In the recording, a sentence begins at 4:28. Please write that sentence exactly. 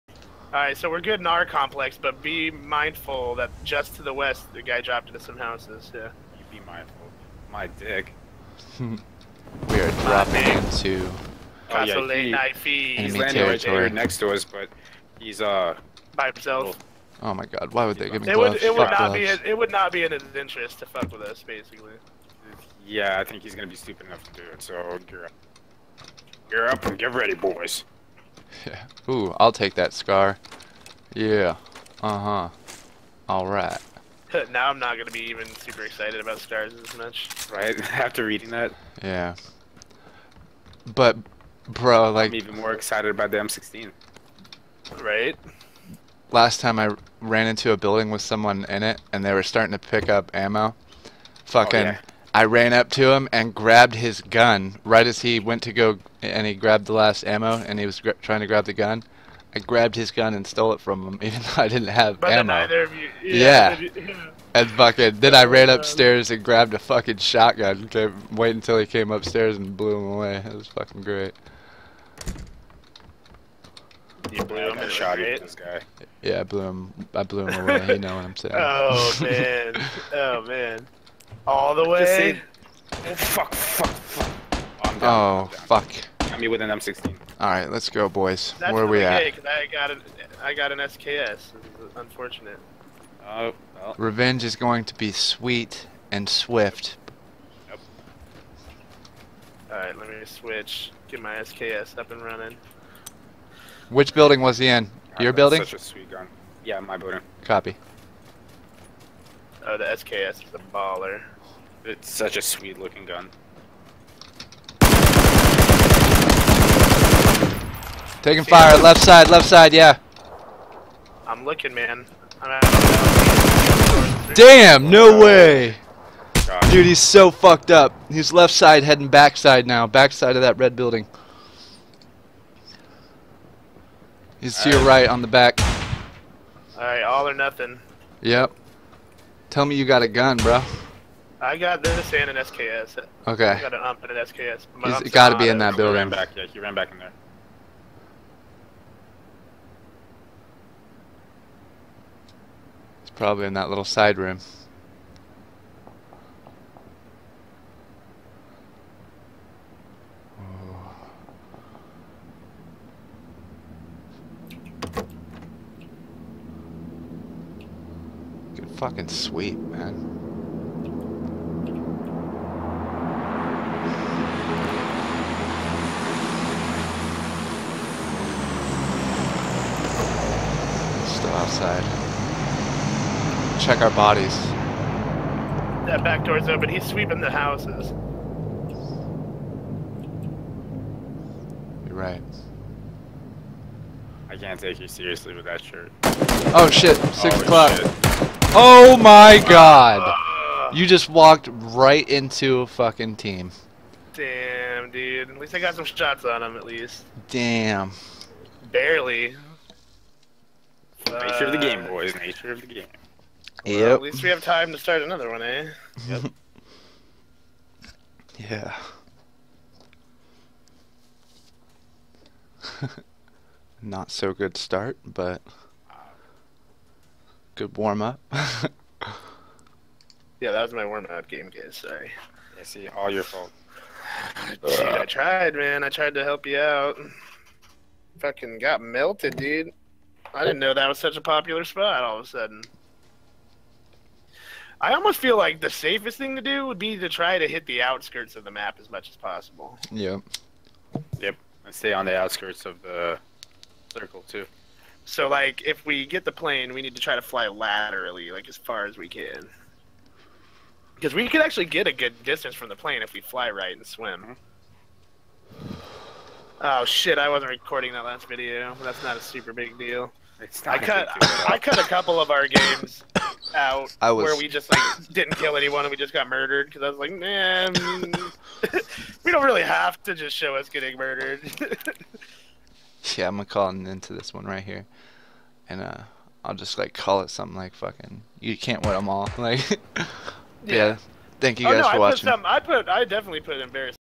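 That's not a super big deal.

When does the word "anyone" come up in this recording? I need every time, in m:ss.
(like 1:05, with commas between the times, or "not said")
4:35.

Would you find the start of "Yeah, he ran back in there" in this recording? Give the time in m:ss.
2:26.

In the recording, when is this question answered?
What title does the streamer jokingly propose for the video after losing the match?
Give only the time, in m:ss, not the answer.
4:48.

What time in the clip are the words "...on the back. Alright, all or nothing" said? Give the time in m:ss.
2:15.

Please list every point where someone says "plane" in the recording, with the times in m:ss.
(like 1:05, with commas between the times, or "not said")
4:16, 4:22.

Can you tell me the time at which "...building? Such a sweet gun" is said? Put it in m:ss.
1:45.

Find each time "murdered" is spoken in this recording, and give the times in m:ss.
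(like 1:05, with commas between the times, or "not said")
4:36, 4:40.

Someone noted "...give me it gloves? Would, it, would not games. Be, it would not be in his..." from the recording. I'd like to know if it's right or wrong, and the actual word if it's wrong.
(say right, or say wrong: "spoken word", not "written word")
wrong: "gloves", not "games".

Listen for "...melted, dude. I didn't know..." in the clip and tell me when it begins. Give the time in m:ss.
3:58.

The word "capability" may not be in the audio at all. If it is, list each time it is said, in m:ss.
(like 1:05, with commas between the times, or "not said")
not said.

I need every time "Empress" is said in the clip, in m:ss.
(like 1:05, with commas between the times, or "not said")
not said.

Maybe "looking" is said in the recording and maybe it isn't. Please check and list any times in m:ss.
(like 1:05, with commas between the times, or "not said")
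1:52, 2:01.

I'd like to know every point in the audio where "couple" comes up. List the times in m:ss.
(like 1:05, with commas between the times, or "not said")
4:31.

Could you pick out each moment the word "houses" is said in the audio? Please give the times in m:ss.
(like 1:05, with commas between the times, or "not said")
0:05, 3:07.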